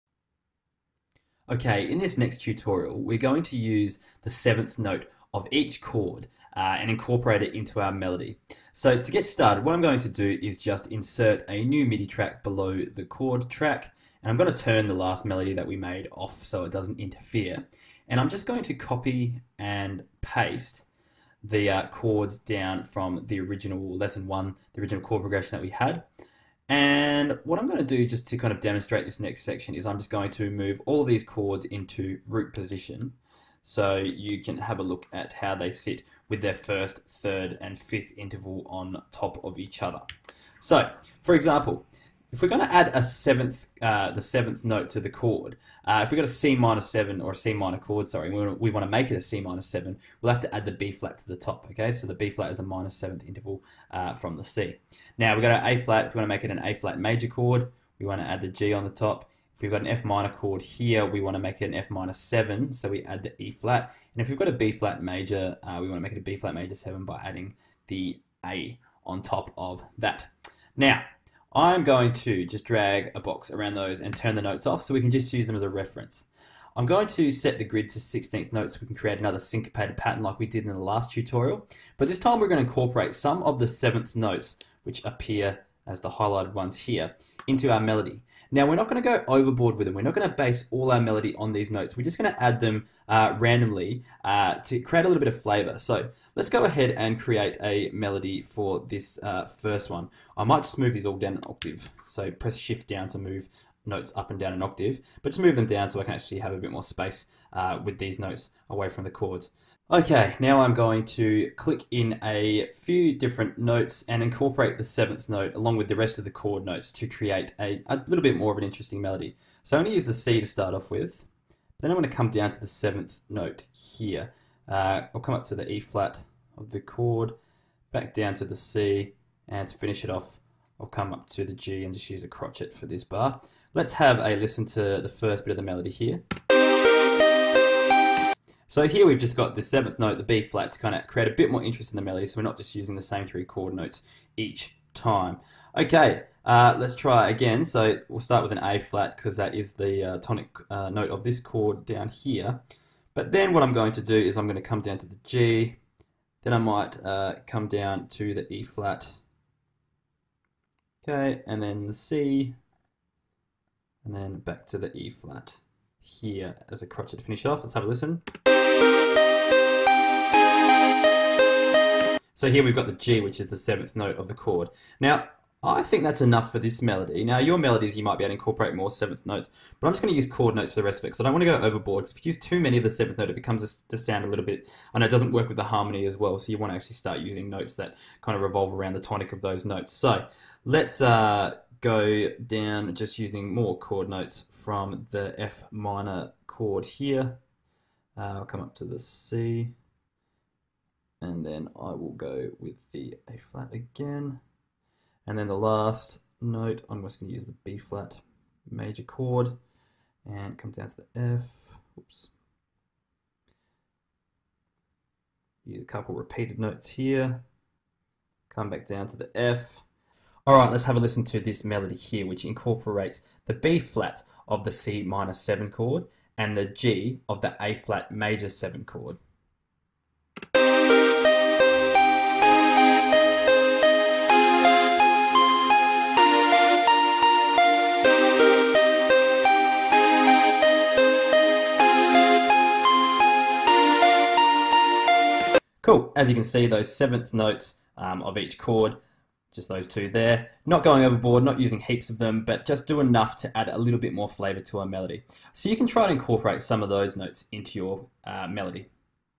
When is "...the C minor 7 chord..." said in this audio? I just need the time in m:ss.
3:44.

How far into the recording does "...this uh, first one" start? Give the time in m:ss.
1:38.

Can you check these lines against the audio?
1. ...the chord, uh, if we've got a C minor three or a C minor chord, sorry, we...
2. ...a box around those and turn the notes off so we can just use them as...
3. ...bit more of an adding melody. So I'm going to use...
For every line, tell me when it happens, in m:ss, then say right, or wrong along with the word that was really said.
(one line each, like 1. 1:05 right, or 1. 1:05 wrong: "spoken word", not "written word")
1. 0:45 wrong: "seven", not "three"
2. 1:13 right
3. 1:58 wrong: "interesting", not "adding".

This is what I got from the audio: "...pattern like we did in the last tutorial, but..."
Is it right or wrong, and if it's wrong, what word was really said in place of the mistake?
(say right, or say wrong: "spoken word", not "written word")
right.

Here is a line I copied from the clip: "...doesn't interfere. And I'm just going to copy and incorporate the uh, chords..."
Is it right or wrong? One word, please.
wrong.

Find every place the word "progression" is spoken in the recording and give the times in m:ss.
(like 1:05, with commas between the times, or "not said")
0:25.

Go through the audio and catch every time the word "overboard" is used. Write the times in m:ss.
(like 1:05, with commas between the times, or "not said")
1:29, 3:01, 4:11.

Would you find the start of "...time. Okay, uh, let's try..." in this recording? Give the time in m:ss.
2:24.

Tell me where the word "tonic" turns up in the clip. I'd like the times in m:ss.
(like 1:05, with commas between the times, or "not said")
2:30, 3:09.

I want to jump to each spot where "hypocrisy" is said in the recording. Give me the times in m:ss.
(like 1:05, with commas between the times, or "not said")
not said.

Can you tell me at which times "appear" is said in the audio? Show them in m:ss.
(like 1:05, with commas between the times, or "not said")
1:25.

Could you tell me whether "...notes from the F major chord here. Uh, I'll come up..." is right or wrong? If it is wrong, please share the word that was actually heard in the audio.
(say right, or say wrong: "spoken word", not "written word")
wrong: "minor", not "major".